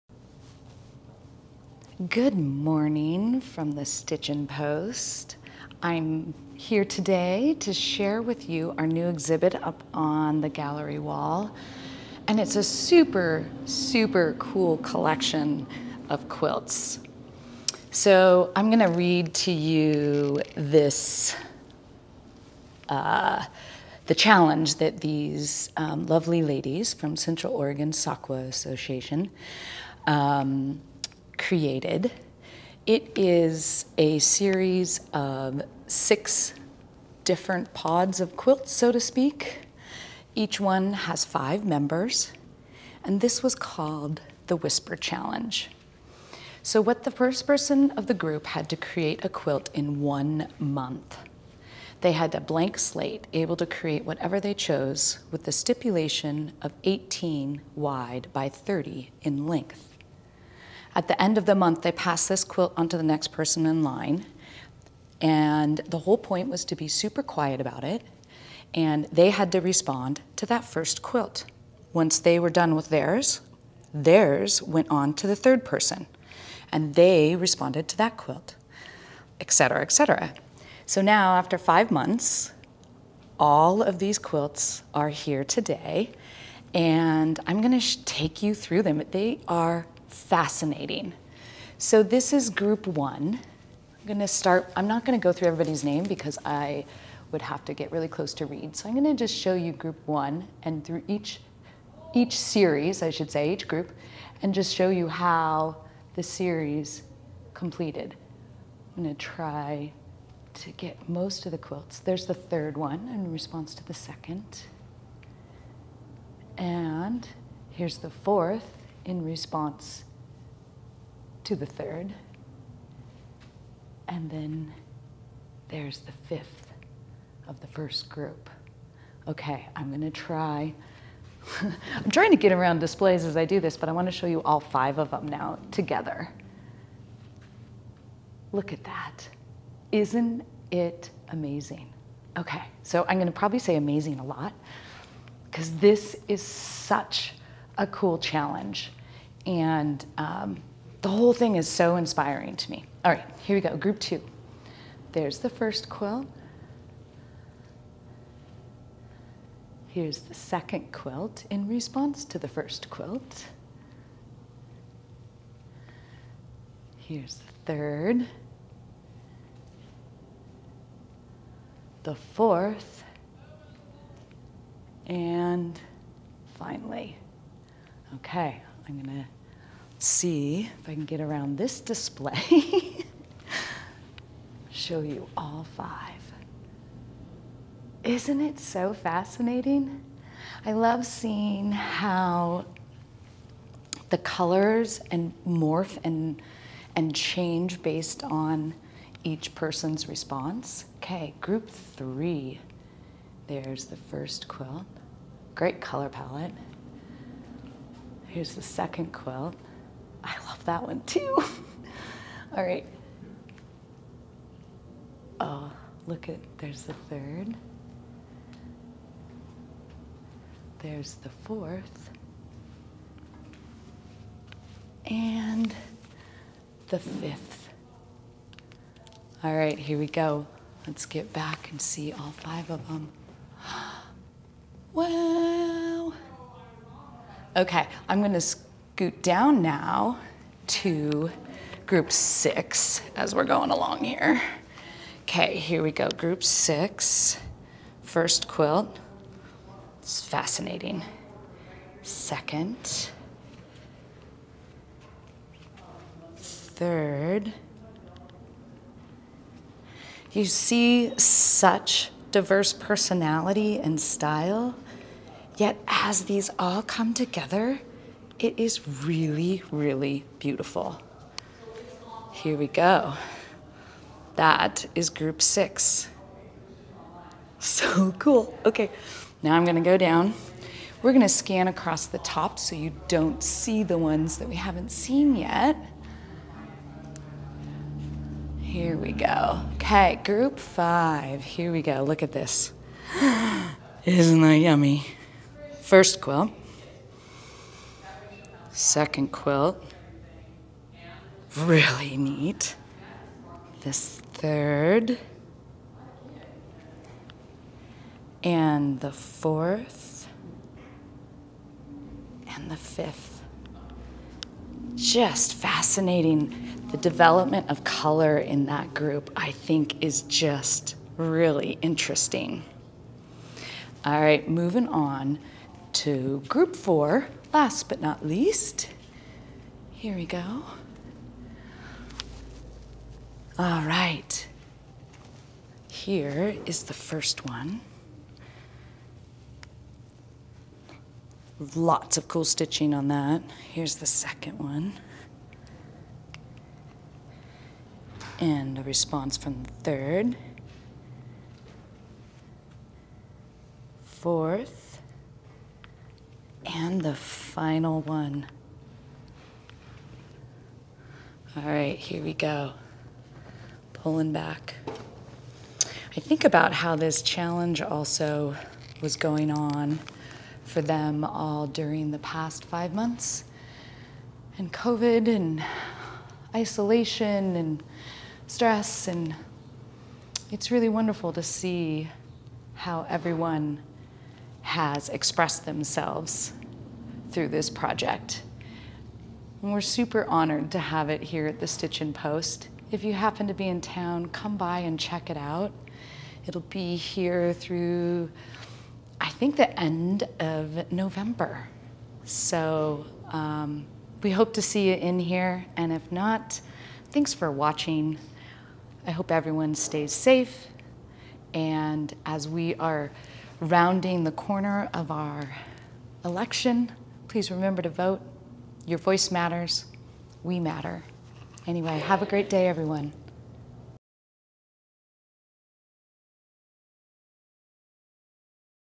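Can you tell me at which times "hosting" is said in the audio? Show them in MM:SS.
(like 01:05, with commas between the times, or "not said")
not said.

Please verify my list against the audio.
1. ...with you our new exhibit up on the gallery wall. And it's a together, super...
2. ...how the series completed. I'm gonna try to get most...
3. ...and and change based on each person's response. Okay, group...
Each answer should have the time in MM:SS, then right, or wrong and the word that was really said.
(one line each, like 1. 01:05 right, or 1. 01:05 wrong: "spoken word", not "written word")
1. 00:08 wrong: "super", not "together"
2. 01:45 right
3. 03:16 right.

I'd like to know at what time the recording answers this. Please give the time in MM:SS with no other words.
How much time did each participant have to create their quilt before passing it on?
00:50.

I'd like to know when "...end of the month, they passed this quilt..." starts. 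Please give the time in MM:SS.
01:01.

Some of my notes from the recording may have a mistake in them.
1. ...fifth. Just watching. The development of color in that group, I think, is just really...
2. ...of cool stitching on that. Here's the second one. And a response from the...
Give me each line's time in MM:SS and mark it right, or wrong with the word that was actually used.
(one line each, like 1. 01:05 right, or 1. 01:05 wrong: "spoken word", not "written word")
1. 05:12 wrong: "fascinating", not "watching"
2. 05:42 right.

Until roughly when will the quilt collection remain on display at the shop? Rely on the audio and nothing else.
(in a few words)
end of November.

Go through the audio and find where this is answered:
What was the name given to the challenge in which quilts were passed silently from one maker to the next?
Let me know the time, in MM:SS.
00:44.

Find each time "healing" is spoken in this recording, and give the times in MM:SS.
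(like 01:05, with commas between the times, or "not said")
not said.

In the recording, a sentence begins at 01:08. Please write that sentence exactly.
And they had to respond to that first quilt.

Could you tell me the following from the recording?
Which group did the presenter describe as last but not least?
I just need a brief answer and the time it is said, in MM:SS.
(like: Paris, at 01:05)
group four, at 05:26.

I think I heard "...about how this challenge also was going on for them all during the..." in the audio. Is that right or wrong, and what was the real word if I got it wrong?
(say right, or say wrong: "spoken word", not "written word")
right.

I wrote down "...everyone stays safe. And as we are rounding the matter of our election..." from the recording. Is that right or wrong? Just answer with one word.
wrong.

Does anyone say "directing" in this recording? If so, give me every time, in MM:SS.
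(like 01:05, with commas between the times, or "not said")
not said.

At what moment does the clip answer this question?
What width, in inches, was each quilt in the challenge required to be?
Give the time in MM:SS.
00:56.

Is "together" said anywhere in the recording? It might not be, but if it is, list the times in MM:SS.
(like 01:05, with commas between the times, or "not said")
02:15, 04:27.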